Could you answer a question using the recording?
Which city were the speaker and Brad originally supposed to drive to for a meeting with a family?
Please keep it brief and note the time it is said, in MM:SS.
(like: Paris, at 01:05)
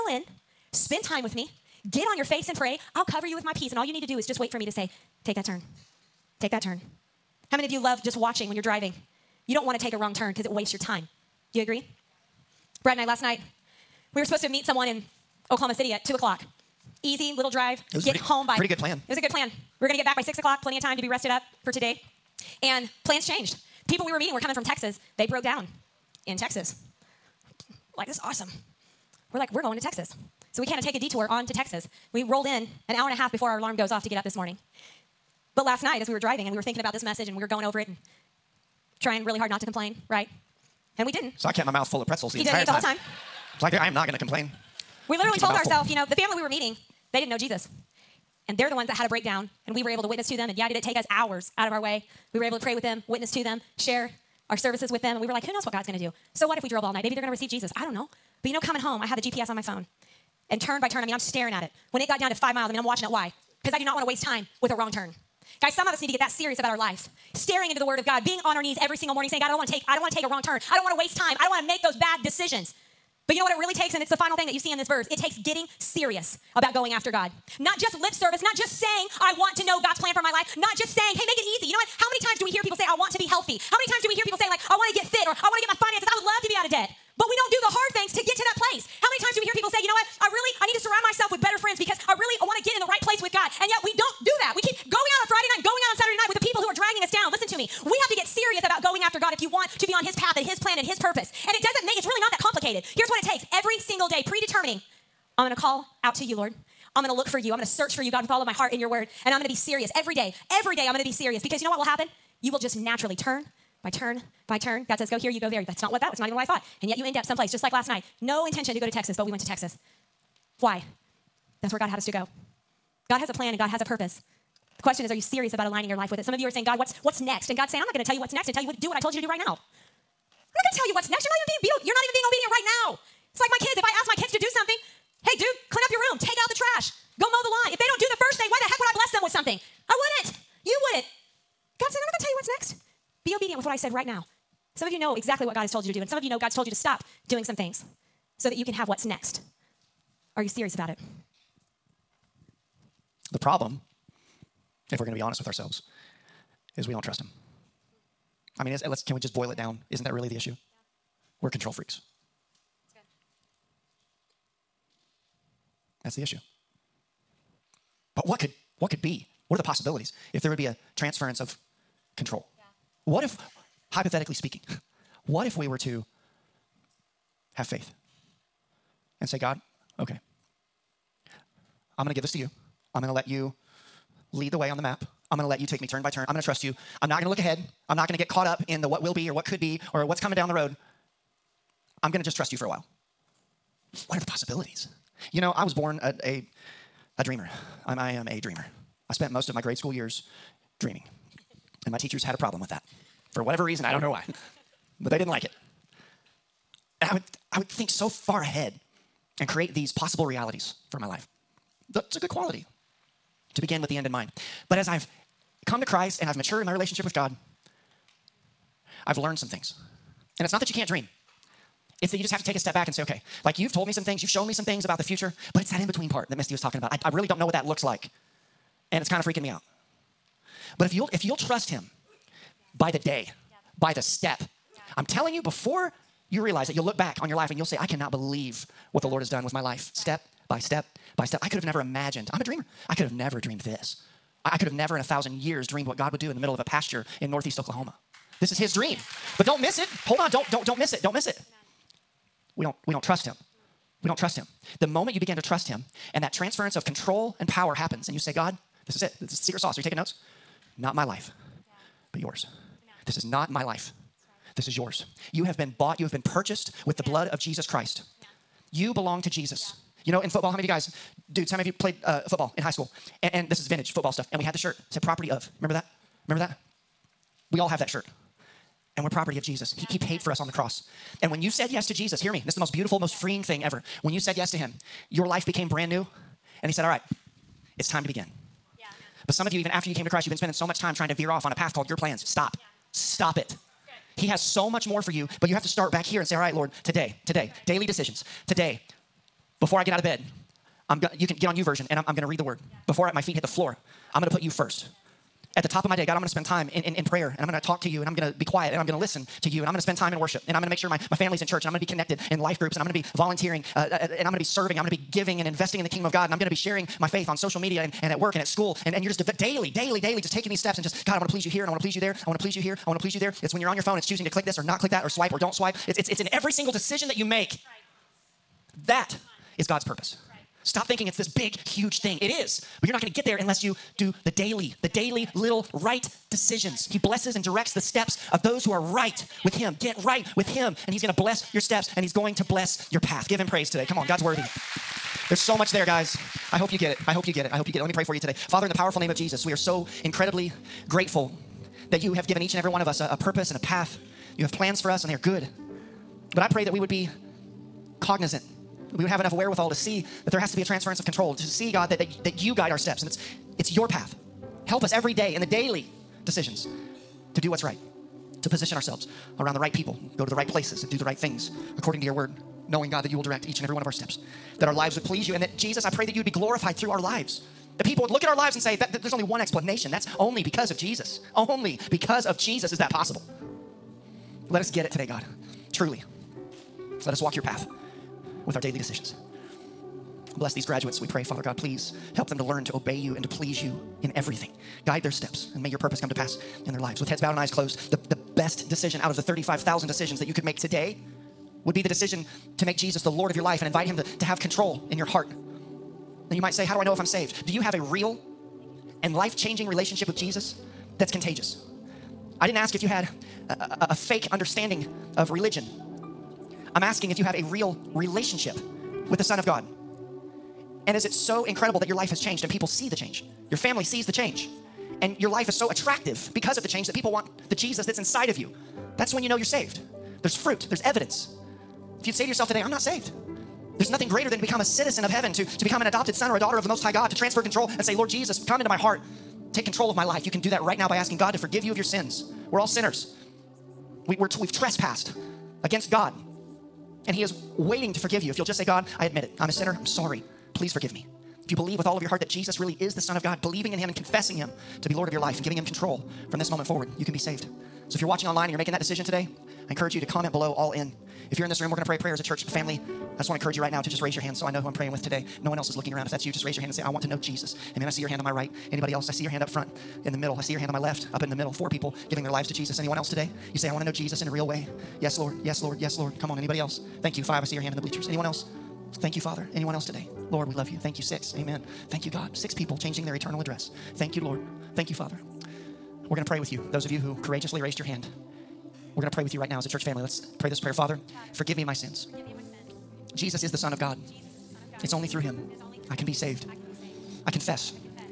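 Oklahoma City, at 00:15.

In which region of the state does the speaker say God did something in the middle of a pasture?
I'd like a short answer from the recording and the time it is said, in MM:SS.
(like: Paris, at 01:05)
northeast Oklahoma, at 04:07.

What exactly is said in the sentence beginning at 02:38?
I mean, is, let's can we just boil it down?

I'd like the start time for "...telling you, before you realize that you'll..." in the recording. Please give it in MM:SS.
03:55.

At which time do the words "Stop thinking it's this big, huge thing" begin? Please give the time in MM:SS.
05:30.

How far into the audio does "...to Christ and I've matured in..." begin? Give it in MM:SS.
03:35.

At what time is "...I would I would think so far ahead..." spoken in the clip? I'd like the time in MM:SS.
03:27.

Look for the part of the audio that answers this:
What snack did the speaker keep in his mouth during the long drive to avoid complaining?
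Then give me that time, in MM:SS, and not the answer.
00:42.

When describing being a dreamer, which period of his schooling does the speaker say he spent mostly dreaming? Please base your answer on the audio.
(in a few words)
grade school.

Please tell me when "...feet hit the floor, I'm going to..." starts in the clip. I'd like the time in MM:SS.
05:03.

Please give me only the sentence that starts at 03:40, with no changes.
And it's not that you can't dream.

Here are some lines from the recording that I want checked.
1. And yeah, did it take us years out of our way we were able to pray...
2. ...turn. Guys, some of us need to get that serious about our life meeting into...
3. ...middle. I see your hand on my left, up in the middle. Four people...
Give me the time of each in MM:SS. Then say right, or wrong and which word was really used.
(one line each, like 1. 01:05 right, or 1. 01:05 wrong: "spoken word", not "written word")
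1. 00:50 wrong: "hours", not "years"
2. 01:04 wrong: "staring", not "meeting"
3. 07:50 right.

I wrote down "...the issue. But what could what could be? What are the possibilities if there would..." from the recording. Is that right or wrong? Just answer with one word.
right.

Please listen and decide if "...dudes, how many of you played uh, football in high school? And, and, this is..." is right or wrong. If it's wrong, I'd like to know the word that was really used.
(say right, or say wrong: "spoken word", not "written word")
right.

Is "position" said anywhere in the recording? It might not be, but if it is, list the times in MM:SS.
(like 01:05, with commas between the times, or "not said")
06:08.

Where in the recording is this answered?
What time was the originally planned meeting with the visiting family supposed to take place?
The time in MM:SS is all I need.
00:16.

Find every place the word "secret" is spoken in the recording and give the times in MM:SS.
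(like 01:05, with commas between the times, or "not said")
04:19.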